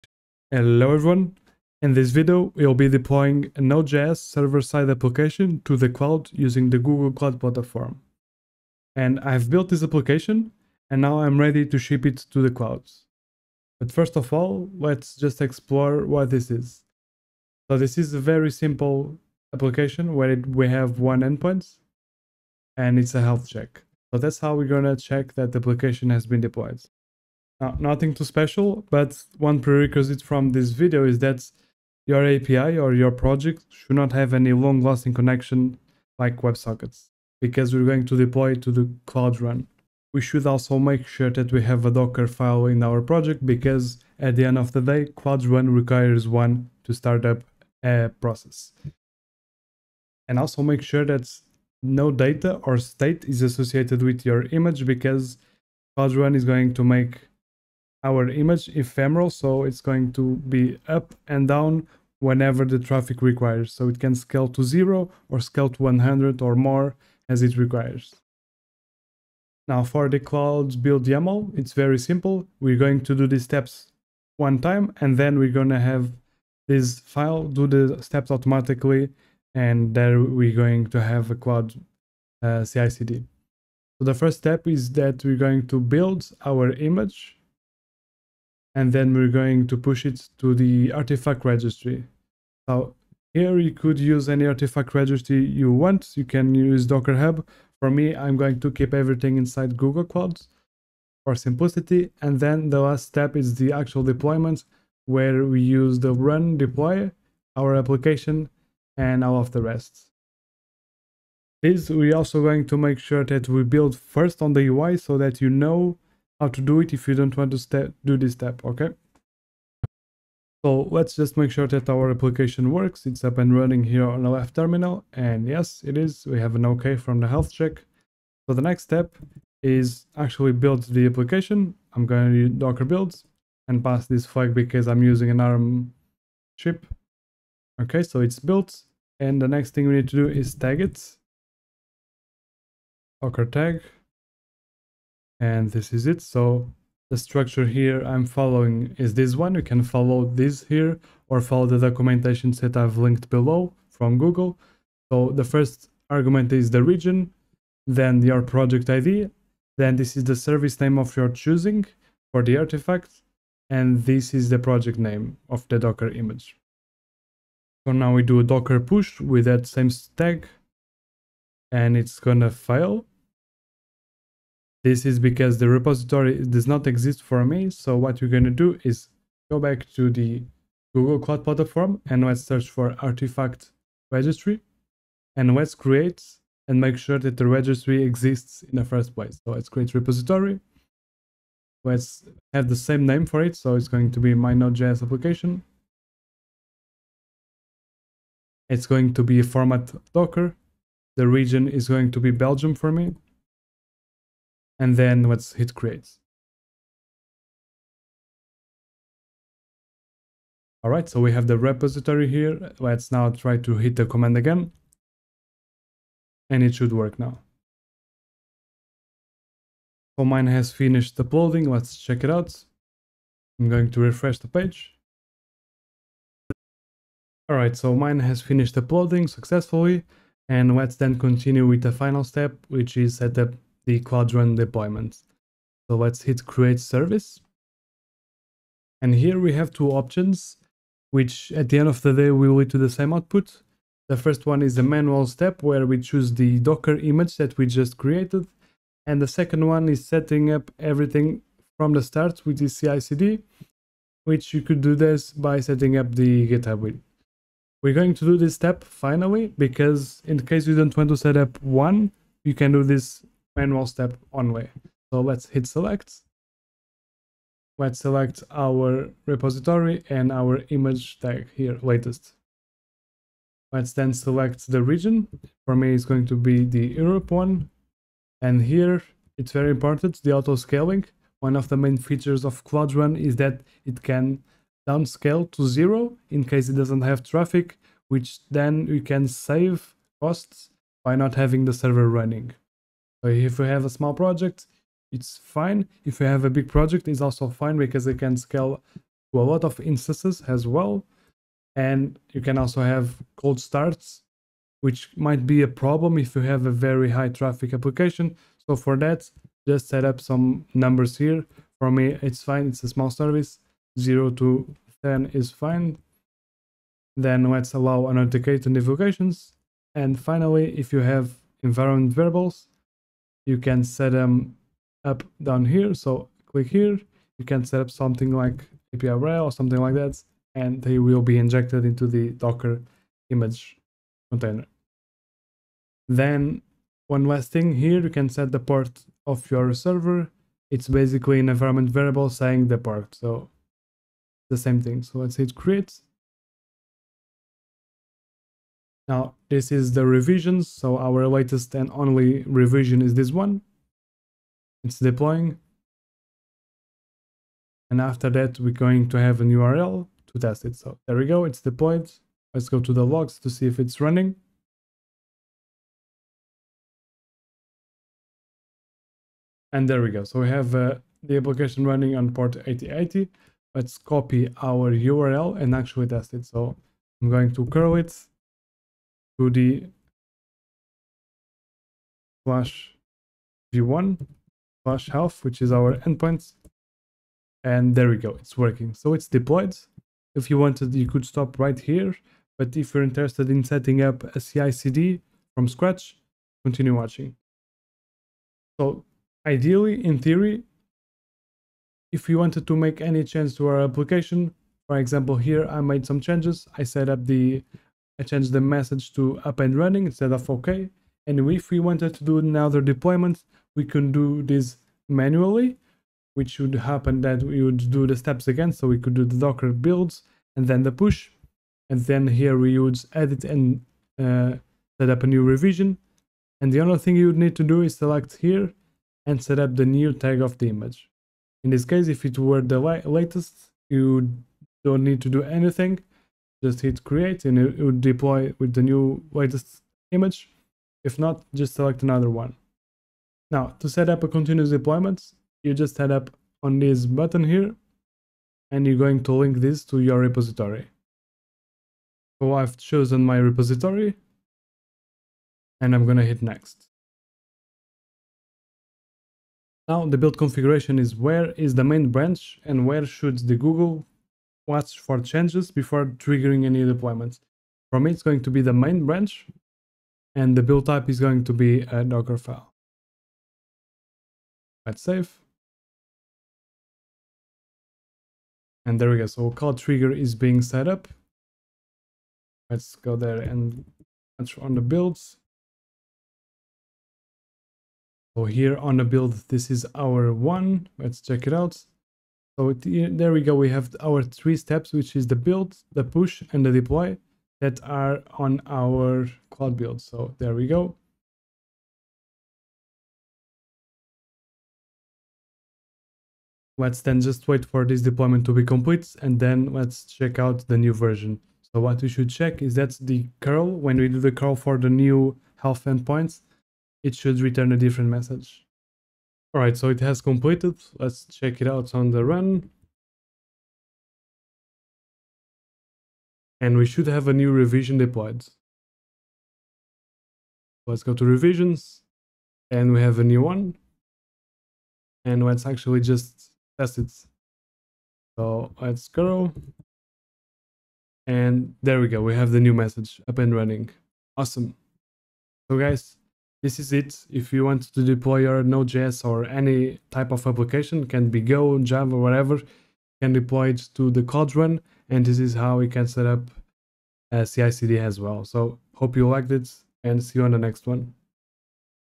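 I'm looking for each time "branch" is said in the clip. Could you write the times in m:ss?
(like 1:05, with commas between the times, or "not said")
7:42, 7:49.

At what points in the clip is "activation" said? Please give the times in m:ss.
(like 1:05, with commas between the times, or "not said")
not said.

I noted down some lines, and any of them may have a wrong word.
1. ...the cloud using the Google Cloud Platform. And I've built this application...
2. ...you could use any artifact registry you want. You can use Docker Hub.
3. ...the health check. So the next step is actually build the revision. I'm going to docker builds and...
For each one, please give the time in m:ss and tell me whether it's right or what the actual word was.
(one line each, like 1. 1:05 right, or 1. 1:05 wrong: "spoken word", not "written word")
1. 0:05 right
2. 1:33 right
3. 2:07 wrong: "application", not "revision".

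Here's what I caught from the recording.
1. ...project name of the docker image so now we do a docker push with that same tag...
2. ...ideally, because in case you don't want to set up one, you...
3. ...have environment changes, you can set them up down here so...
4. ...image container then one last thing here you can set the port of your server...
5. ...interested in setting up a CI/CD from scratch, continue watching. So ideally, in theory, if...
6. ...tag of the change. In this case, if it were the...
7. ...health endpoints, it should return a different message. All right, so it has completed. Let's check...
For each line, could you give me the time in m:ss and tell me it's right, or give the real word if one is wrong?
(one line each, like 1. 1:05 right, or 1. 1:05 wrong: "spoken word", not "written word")
1. 2:44 right
2. 4:18 wrong: "finally", not "ideally"
3. 5:20 wrong: "variables", not "changes"
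4. 5:33 right
5. 6:33 right
6. 7:10 wrong: "image", not "change"
7. 8:35 right.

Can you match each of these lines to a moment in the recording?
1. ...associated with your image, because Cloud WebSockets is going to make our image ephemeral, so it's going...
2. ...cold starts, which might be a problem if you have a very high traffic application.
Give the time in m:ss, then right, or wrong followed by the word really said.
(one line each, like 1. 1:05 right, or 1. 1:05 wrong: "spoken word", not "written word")
1. 0:53 wrong: "Run", not "WebSockets"
2. 5:03 right.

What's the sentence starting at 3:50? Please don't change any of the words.
And let's then continue with the final step, which is set up the Cloud Run deployment.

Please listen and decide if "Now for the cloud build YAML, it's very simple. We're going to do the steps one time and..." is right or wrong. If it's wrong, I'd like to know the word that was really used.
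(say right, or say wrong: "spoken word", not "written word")
right.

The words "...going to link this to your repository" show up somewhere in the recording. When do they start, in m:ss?
7:28.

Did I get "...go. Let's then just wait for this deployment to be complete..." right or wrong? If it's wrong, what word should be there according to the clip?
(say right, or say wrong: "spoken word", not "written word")
right.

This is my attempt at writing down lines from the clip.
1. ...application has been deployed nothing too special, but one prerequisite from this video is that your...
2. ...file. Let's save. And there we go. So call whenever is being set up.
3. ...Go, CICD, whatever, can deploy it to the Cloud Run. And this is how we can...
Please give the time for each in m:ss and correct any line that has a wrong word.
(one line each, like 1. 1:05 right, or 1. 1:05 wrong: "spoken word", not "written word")
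1. 0:25 right
2. 7:52 wrong: "trigger", not "whenever"
3. 9:11 wrong: "Java", not "CICD".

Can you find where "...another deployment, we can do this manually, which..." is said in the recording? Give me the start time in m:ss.
6:52.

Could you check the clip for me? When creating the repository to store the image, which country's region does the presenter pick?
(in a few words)
Belgium.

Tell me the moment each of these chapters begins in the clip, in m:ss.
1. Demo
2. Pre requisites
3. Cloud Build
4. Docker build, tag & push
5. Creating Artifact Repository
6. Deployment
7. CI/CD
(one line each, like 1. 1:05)
1. 0:10
2. 0:27
3. 1:10
4. 2:00
5. 2:56
6. 3:54
7. 7:21.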